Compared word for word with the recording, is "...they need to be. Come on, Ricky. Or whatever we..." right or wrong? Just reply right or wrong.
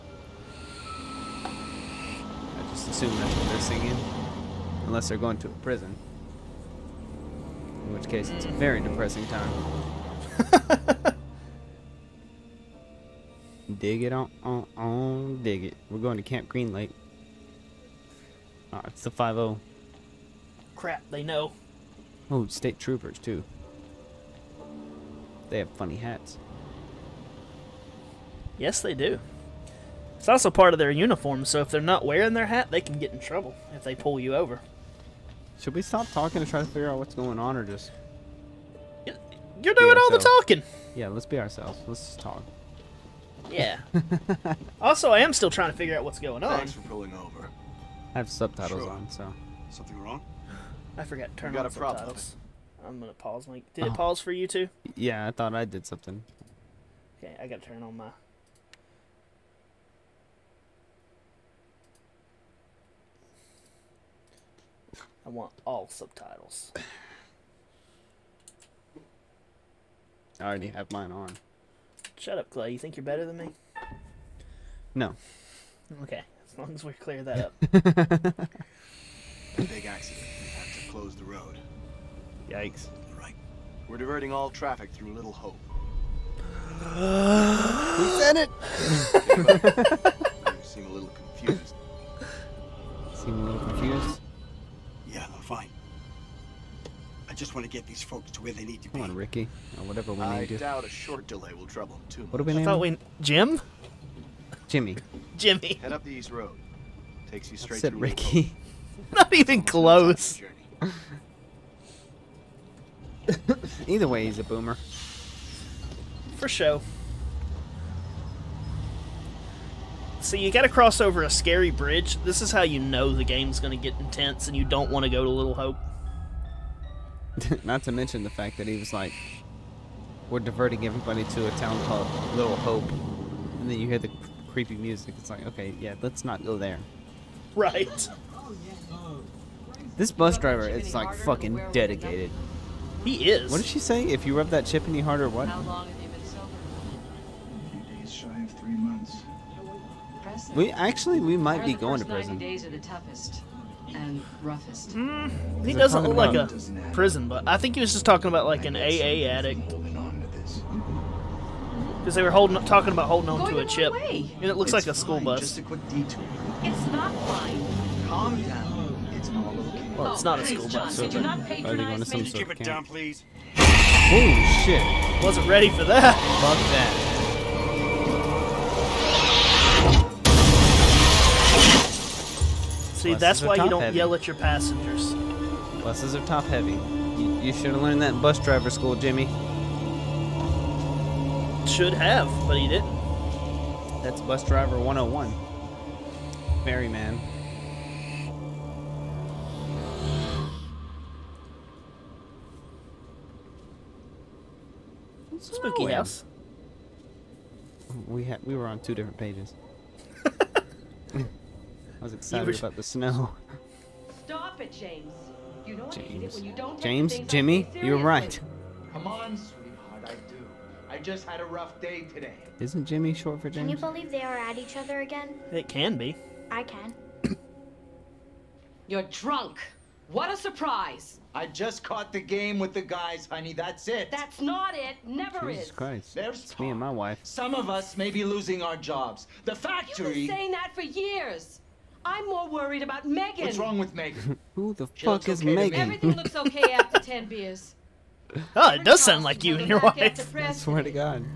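right.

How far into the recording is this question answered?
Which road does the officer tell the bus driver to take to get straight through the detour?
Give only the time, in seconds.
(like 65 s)
106 s.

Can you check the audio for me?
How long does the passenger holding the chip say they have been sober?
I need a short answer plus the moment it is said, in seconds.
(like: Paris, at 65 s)
Days shy of 3 months, at 148 s.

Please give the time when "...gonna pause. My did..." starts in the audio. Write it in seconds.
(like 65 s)
52 s.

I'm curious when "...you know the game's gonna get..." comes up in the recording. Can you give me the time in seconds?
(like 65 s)
122 s.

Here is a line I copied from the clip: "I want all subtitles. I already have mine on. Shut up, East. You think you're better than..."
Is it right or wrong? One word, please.
wrong.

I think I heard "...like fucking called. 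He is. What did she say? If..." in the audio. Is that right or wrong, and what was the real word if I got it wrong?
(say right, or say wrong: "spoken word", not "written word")
wrong: "dedicated", not "called".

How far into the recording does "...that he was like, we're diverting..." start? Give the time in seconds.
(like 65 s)
128 s.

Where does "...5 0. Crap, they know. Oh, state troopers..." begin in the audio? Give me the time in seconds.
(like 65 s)
19 s.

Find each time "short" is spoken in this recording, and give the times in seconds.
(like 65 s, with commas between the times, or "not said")
100 s, 223 s.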